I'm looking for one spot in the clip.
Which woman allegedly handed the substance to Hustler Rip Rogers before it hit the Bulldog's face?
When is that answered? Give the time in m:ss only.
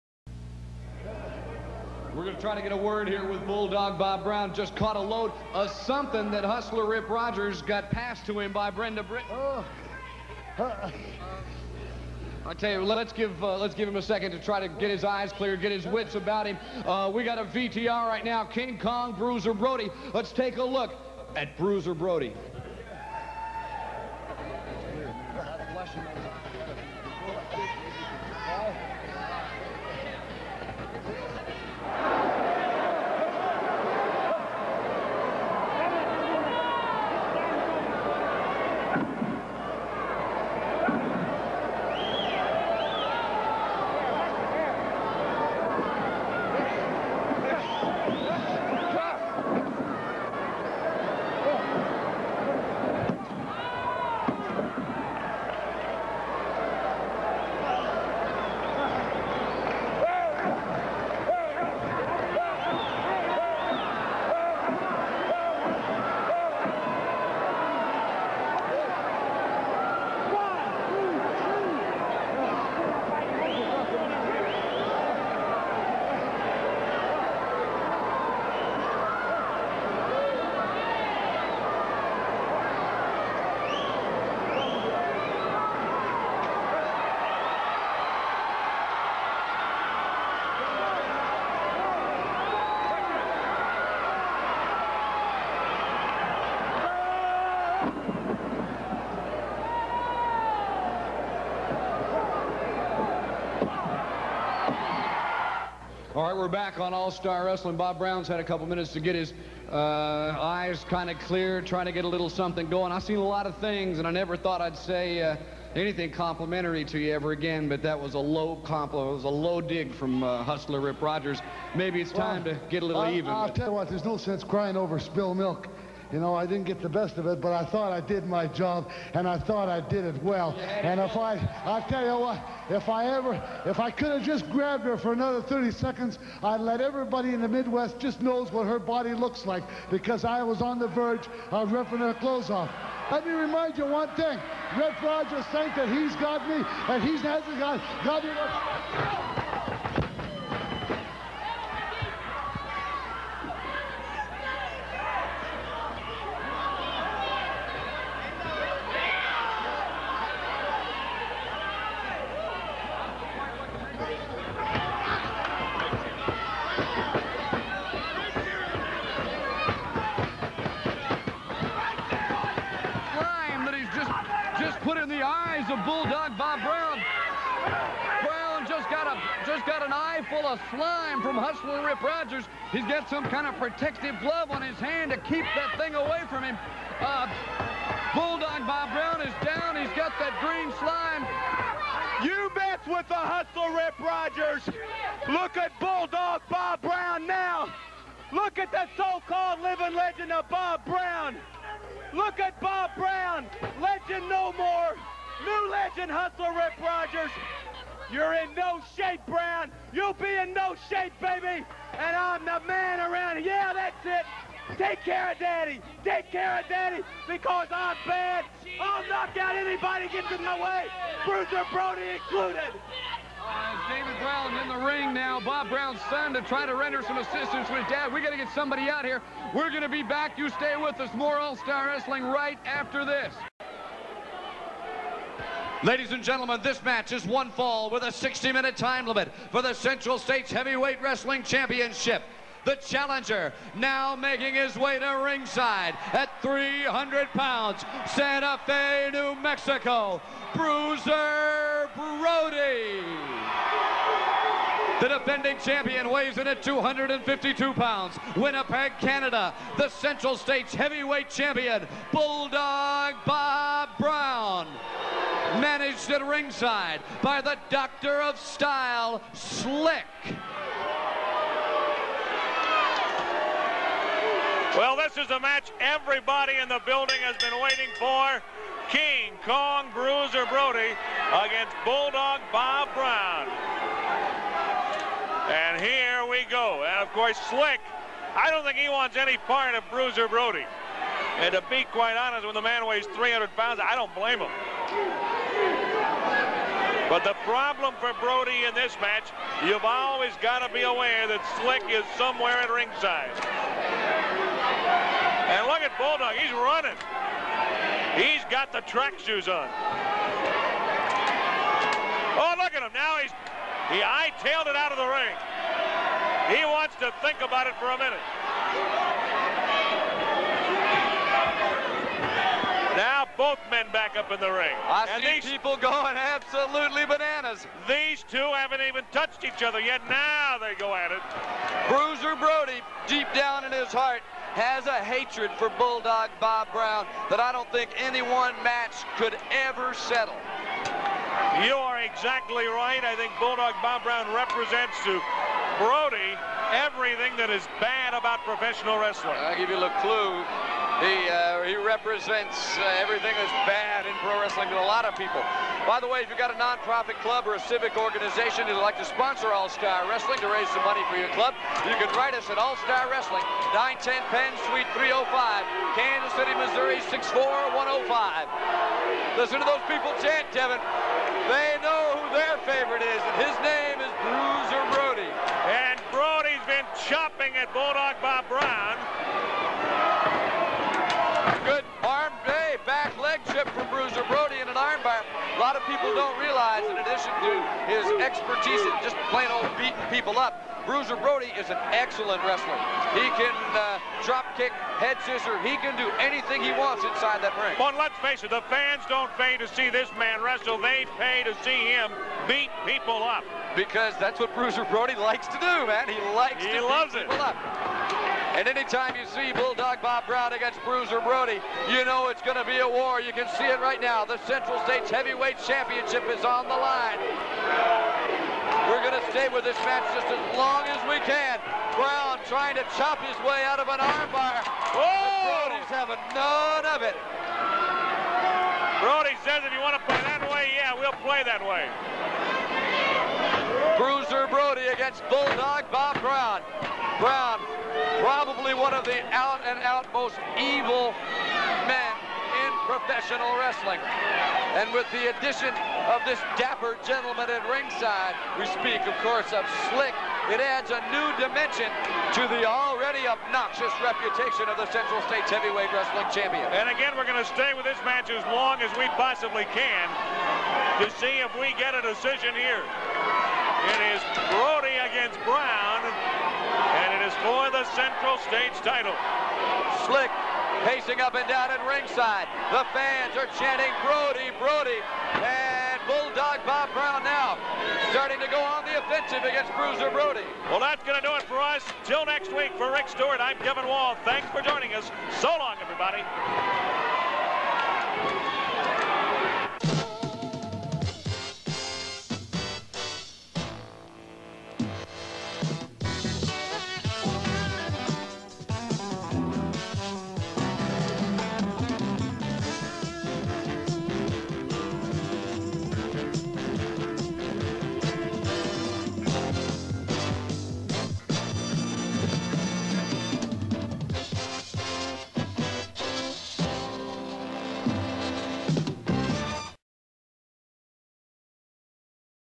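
0:08.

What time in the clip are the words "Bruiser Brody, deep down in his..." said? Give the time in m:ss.
5:31.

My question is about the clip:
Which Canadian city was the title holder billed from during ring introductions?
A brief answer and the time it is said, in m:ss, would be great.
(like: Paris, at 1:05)
Winnipeg, at 4:18.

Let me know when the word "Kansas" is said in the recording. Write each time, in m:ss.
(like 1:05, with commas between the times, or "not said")
6:05.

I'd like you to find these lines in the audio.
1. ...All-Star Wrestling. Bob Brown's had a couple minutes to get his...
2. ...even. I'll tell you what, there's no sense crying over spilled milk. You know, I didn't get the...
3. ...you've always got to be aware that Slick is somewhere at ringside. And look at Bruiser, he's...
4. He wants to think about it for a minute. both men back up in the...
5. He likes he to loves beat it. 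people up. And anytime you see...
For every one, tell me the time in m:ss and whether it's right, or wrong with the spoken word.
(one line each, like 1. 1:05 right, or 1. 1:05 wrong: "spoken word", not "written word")
1. 1:46 right
2. 2:03 right
3. 4:59 wrong: "Bulldog", not "Bruiser"
4. 5:16 right
5. 6:46 right.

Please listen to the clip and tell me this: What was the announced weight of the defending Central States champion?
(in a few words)
252 pounds.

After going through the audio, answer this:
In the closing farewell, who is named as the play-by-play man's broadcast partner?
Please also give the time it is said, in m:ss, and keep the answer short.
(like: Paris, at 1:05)
Rick Stewart, at 8:02.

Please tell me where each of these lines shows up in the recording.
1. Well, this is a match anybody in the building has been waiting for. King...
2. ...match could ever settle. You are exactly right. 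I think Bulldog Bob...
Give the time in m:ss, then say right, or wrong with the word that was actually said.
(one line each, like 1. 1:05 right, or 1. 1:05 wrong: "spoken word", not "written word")
1. 4:34 wrong: "everybody", not "anybody"
2. 5:38 right.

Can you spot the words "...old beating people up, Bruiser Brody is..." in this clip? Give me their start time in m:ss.
6:29.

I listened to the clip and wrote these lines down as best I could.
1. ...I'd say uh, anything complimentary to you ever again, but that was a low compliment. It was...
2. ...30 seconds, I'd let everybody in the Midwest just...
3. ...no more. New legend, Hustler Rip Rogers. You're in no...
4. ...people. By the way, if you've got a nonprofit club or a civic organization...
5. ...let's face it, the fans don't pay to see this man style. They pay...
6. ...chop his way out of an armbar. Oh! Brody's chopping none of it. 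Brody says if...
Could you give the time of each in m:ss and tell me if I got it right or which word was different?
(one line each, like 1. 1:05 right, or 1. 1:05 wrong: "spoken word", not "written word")
1. 1:54 right
2. 2:15 right
3. 3:24 right
4. 5:55 right
5. 6:37 wrong: "wrestle", not "style"
6. 7:02 wrong: "having", not "chopping".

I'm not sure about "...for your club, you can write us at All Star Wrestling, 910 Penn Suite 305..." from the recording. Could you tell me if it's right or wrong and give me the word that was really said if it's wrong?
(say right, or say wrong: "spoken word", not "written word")
right.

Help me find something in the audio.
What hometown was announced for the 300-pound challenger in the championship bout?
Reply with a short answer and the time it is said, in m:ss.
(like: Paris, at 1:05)
Santa Fe, New Mexico, at 4:08.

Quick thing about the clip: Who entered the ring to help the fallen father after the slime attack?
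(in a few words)
David Brown.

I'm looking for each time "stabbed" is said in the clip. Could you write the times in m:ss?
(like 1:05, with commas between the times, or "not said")
not said.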